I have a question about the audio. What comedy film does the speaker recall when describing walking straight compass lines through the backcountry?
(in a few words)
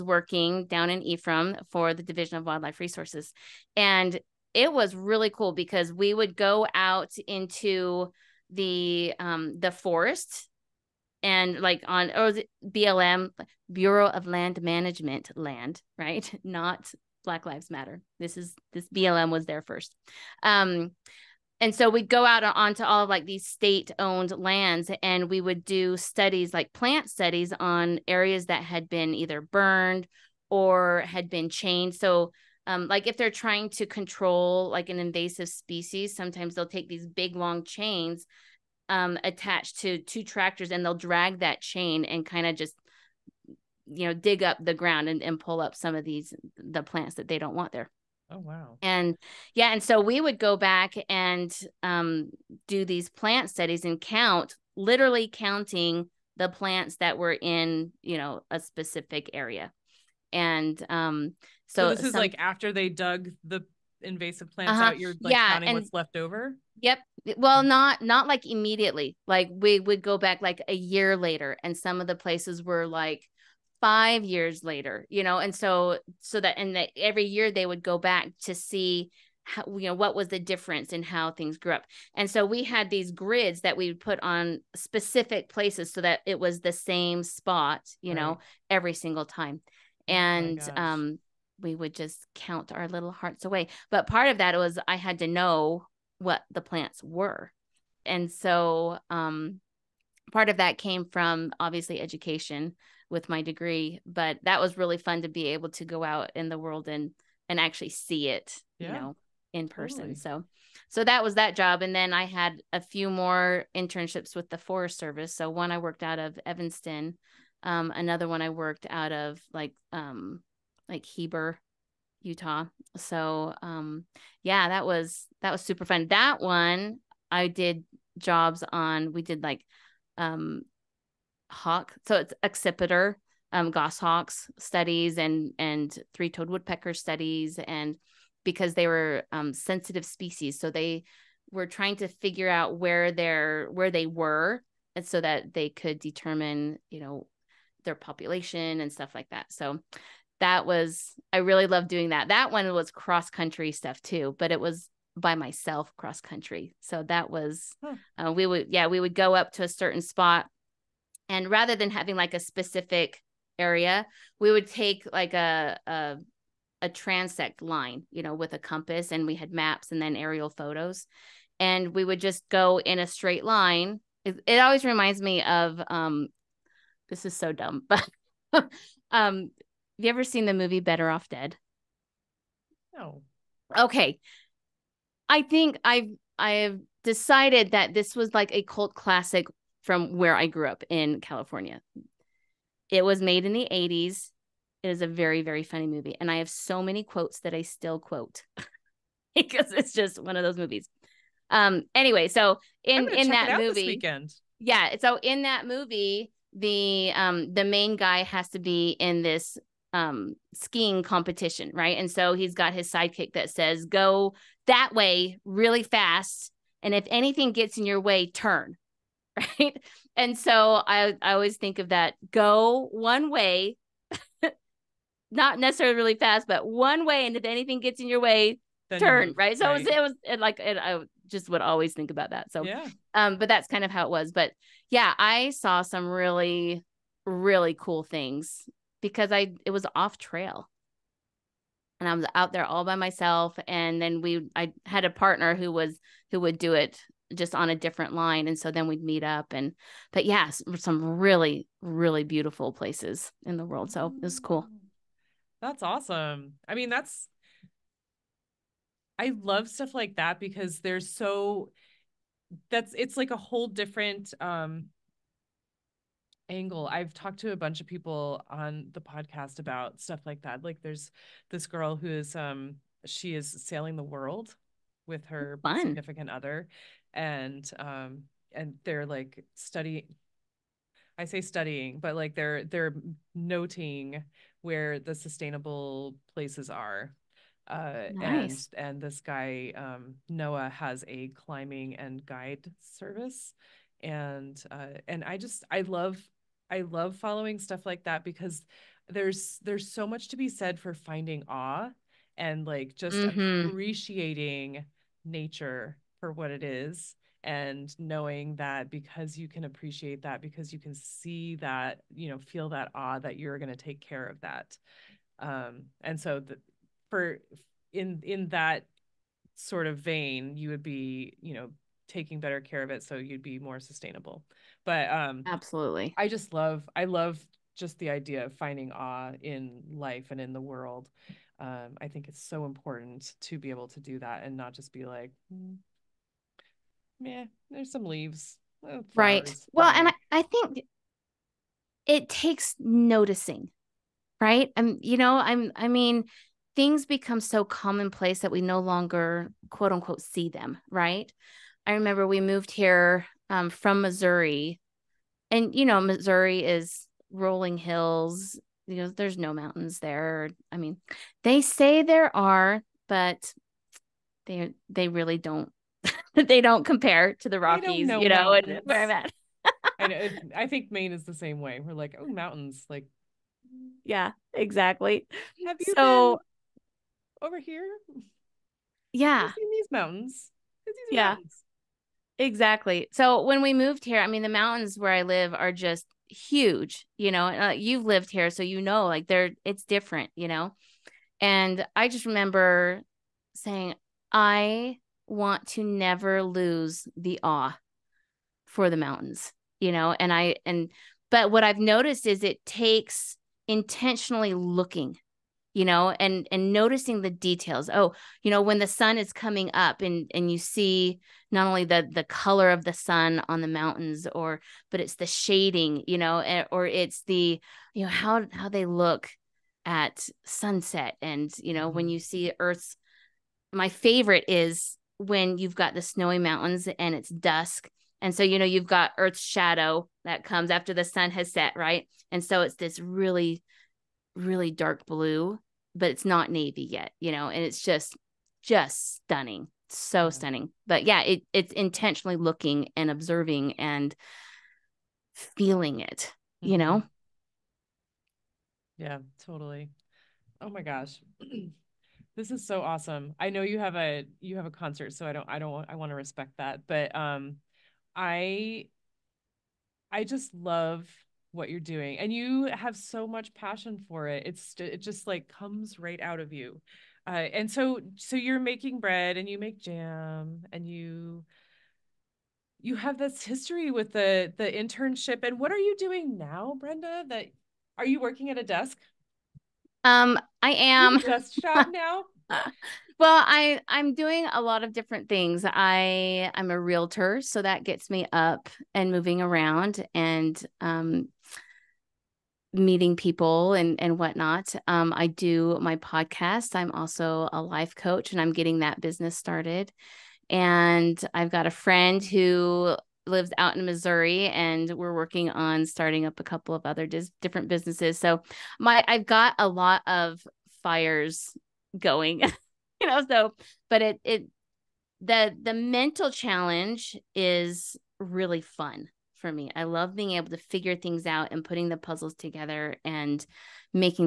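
Better Off Dead.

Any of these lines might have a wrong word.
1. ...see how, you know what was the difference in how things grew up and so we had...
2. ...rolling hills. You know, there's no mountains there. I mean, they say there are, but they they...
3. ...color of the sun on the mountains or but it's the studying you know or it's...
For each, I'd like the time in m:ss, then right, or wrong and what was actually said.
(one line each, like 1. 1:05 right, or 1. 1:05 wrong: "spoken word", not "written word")
1. 1:18 right
2. 5:57 right
3. 6:52 wrong: "shading", not "studying".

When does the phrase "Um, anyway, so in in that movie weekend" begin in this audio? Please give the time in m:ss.
3:21.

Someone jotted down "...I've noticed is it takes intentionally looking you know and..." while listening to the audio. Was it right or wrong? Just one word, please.
right.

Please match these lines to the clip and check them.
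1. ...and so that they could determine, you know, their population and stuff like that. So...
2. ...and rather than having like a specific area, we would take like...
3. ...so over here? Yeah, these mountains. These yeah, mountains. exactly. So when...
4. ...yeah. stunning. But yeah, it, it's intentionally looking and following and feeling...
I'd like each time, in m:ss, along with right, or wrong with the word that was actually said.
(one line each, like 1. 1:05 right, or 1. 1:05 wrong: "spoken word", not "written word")
1. 2:24 right
2. 2:41 right
3. 6:15 right
4. 7:20 wrong: "observing", not "following".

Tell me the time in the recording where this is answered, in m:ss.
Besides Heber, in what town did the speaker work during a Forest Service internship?
1:56.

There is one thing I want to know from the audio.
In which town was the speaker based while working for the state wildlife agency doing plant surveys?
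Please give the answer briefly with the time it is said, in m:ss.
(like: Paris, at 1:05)
Ephraim, at 0:01.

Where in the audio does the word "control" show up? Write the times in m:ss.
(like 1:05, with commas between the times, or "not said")
0:33.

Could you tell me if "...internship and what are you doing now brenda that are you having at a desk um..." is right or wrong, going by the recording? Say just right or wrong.
wrong.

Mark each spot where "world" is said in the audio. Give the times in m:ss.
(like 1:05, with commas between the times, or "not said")
1:46, 4:13, 4:34, 5:30.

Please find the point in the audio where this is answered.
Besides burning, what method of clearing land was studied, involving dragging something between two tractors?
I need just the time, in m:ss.
0:31.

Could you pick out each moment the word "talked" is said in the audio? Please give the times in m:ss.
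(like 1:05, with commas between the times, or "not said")
4:27.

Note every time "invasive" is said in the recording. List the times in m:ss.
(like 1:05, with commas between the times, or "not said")
0:34, 1:04.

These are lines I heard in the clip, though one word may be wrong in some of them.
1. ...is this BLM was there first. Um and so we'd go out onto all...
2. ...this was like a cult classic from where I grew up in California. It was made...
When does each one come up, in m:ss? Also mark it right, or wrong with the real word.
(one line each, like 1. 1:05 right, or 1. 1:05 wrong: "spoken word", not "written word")
1. 0:18 right
2. 3:07 right.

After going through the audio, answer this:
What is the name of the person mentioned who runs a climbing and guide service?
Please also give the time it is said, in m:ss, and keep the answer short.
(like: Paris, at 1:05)
Noah, at 4:50.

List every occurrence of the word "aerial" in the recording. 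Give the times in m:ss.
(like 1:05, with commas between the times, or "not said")
2:50.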